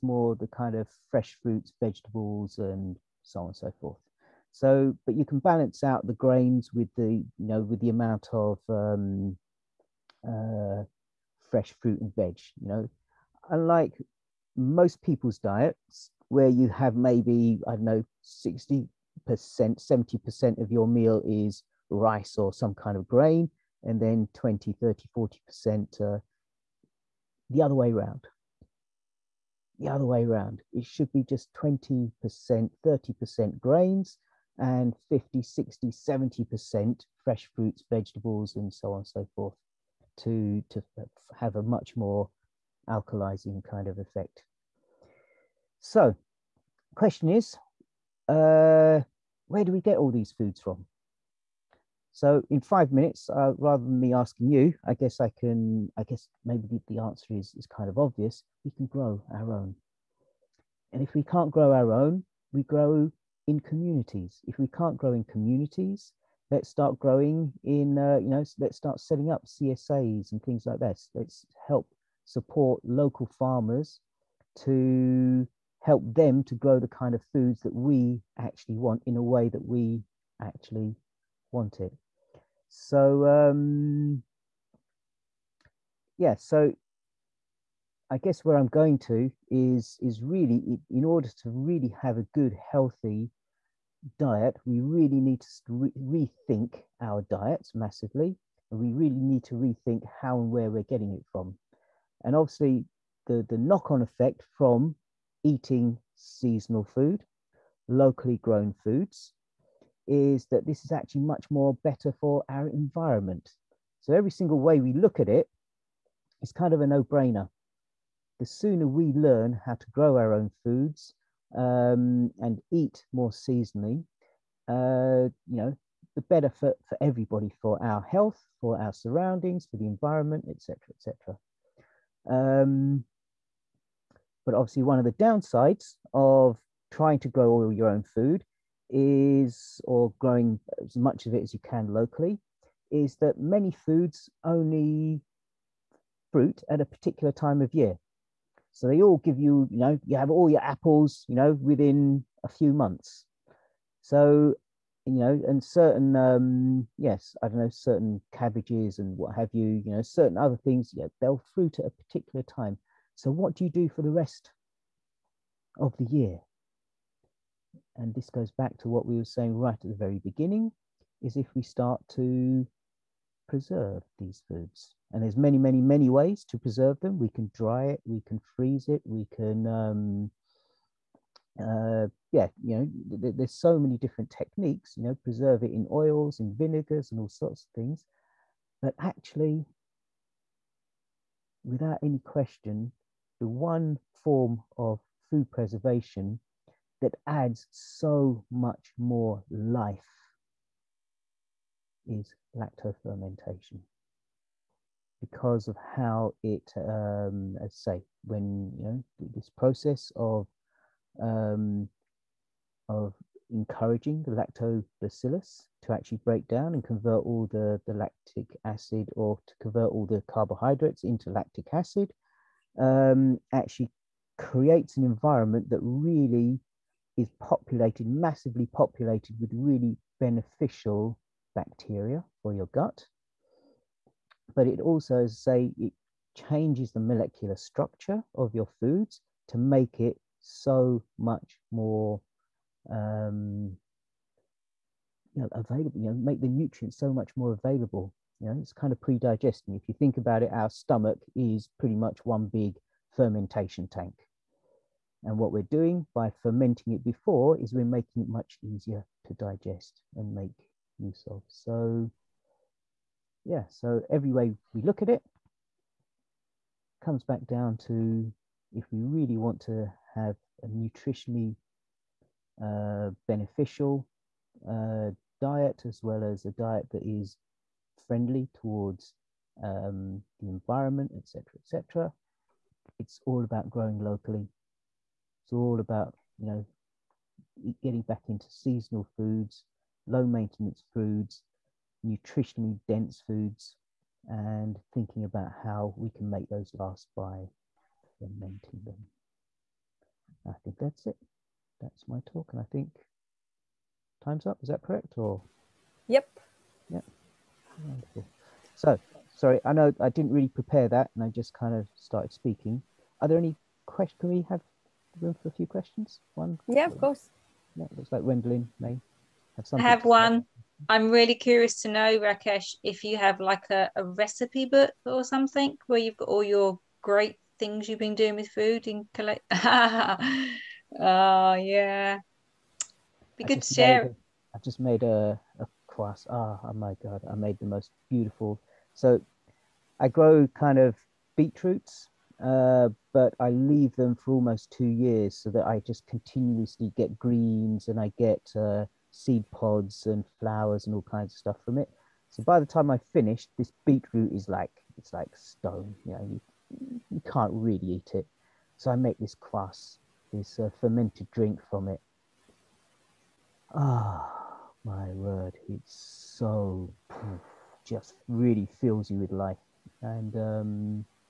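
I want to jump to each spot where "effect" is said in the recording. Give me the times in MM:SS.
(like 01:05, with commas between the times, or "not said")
00:43, 01:44.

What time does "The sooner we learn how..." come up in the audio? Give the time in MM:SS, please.
01:58.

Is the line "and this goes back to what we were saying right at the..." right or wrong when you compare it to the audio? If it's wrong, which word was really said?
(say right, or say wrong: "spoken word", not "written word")
right.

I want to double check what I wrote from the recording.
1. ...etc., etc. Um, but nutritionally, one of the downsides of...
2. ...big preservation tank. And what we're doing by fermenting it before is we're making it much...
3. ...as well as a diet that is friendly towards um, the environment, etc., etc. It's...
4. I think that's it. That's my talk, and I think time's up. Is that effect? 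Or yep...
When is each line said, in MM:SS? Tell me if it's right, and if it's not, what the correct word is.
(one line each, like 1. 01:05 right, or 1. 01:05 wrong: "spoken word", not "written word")
1. 02:10 wrong: "obviously", not "nutritionally"
2. 04:12 wrong: "fermentation", not "preservation"
3. 04:35 right
4. 05:00 wrong: "correct", not "effect".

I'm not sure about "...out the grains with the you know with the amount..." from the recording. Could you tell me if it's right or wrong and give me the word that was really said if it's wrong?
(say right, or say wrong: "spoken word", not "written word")
right.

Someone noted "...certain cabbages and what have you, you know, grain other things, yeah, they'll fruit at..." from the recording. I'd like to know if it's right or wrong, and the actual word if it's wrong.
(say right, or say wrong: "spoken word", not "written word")
wrong: "certain", not "grain".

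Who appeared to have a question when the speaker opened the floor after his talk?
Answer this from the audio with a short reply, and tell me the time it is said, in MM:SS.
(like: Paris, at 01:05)
Wendelin, at 05:18.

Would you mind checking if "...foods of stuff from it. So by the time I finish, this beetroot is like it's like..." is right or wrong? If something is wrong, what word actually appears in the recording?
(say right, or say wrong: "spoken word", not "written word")
wrong: "kinds", not "foods".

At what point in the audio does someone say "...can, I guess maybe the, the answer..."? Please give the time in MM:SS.
00:55.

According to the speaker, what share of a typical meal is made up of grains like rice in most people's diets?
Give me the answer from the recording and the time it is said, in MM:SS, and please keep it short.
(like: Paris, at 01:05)
60-70%, at 00:18.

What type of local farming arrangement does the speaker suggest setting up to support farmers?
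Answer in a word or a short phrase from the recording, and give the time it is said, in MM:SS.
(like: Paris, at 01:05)
CSAs, at 01:09.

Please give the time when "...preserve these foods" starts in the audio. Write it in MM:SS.
02:53.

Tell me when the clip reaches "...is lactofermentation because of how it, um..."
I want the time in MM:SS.
03:22.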